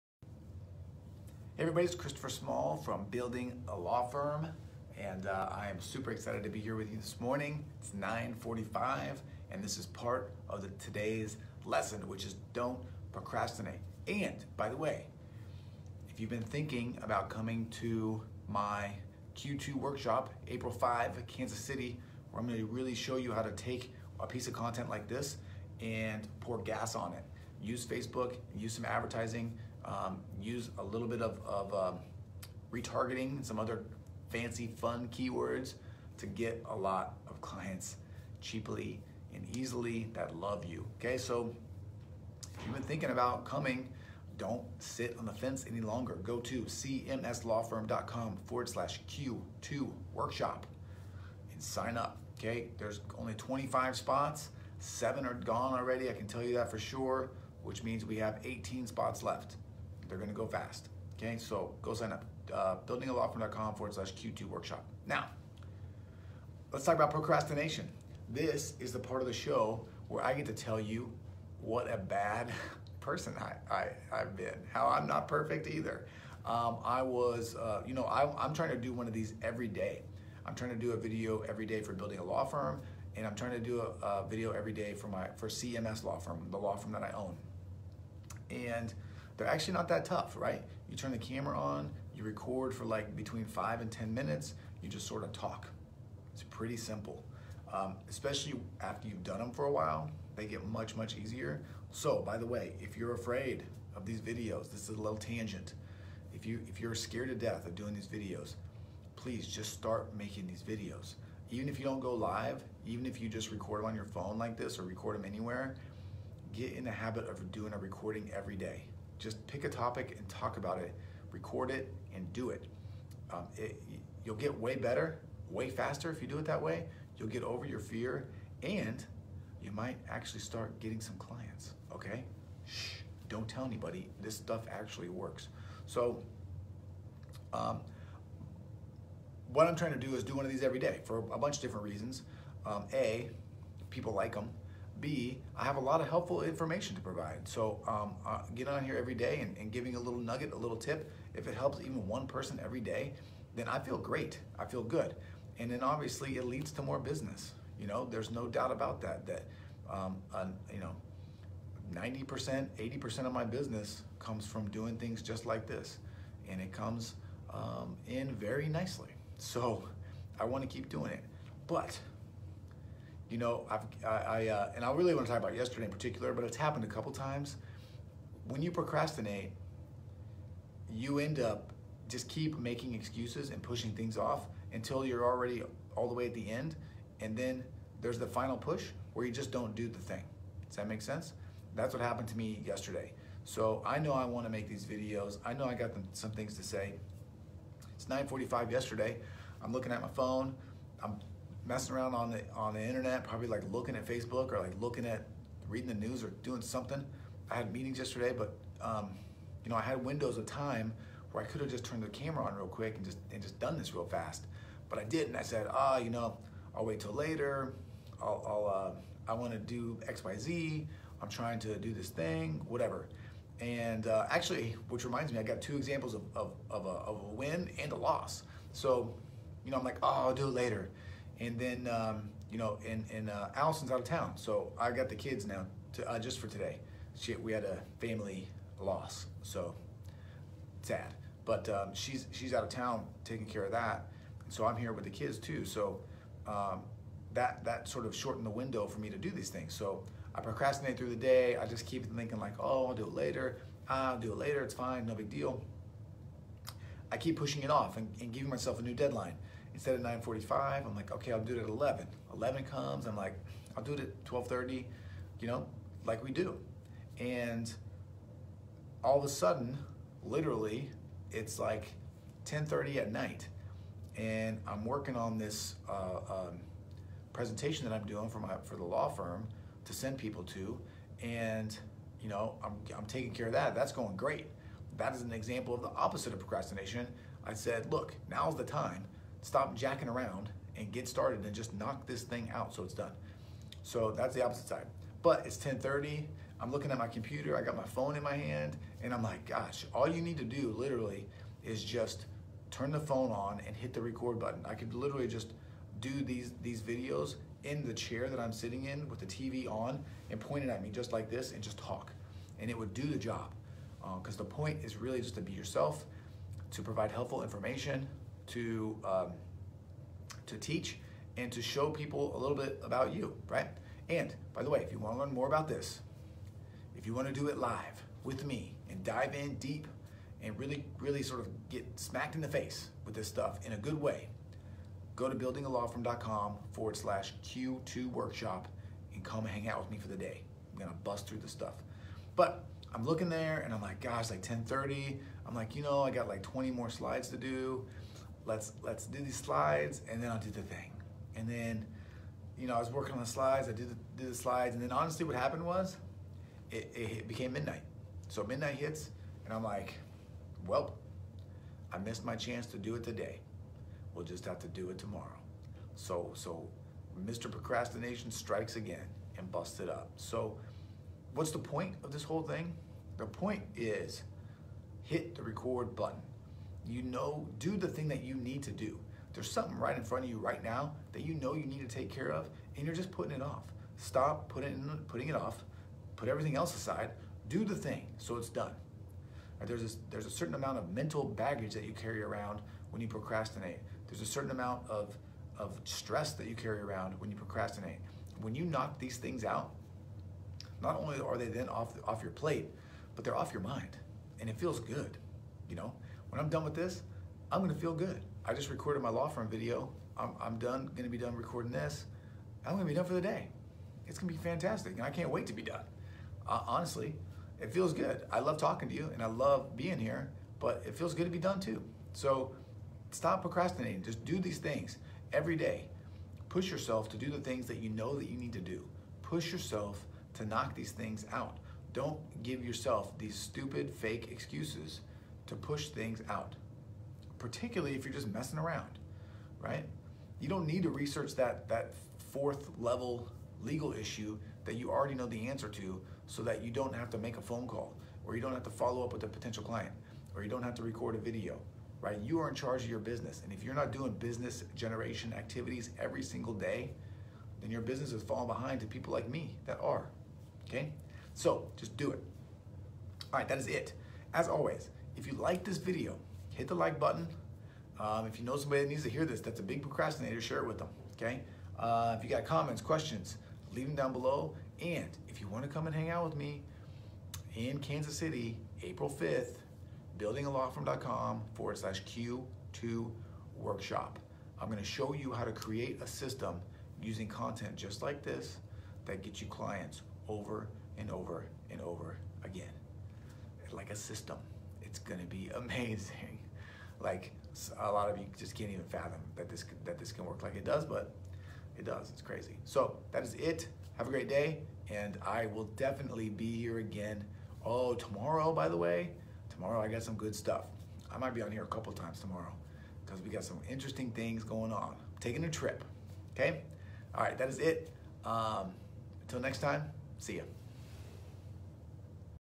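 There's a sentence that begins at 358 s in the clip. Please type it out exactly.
So midnight hits and I'm like, well, I missed my chance to do it today.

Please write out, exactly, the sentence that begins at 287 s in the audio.
I said, look, now's the time stop jacking around and get started and just knock this thing out so it's done.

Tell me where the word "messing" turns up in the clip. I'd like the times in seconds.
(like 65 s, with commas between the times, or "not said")
201 s, 438 s.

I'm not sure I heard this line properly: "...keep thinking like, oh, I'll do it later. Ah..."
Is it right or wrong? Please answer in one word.
right.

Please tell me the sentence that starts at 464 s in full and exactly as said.
As always, if you like this video, hit the like button.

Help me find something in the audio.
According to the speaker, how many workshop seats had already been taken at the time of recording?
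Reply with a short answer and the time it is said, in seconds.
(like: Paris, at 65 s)
7, at 54 s.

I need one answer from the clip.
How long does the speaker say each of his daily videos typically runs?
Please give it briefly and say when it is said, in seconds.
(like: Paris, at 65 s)
5 to 10 minutes, at 93 s.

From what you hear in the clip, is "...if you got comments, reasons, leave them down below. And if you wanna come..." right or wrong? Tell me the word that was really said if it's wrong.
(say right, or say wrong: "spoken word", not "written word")
wrong: "questions", not "reasons".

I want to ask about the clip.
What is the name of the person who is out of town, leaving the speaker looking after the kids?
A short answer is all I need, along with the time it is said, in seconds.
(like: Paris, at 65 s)
Allison, at 233 s.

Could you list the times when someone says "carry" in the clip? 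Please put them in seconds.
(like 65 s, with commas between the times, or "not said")
391 s, 396 s.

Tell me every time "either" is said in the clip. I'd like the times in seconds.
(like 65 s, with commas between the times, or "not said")
75 s.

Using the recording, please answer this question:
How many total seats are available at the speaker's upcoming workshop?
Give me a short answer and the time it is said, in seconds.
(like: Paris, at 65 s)
25, at 53 s.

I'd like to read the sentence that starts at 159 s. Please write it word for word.
That, um, uh, you know, 90%, 80% of my business comes from doing things just like this.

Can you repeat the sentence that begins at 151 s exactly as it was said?
If it helps even one person every day, then I feel great.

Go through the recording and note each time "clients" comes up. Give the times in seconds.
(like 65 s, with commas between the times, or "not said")
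37 s, 131 s, 449 s, 489 s.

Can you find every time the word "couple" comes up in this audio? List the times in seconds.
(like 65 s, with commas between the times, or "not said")
176 s, 511 s.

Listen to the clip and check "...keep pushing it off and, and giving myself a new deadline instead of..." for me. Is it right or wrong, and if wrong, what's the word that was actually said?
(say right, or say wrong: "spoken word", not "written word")
right.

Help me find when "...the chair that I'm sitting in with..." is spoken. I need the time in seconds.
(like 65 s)
307 s.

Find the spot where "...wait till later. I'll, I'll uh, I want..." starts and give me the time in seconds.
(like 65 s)
216 s.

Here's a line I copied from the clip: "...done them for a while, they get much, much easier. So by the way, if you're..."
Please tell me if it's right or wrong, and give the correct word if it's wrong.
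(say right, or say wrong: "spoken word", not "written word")
right.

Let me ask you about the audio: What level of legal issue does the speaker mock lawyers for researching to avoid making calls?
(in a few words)
Fourth level.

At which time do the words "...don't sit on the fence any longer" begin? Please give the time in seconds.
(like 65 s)
44 s.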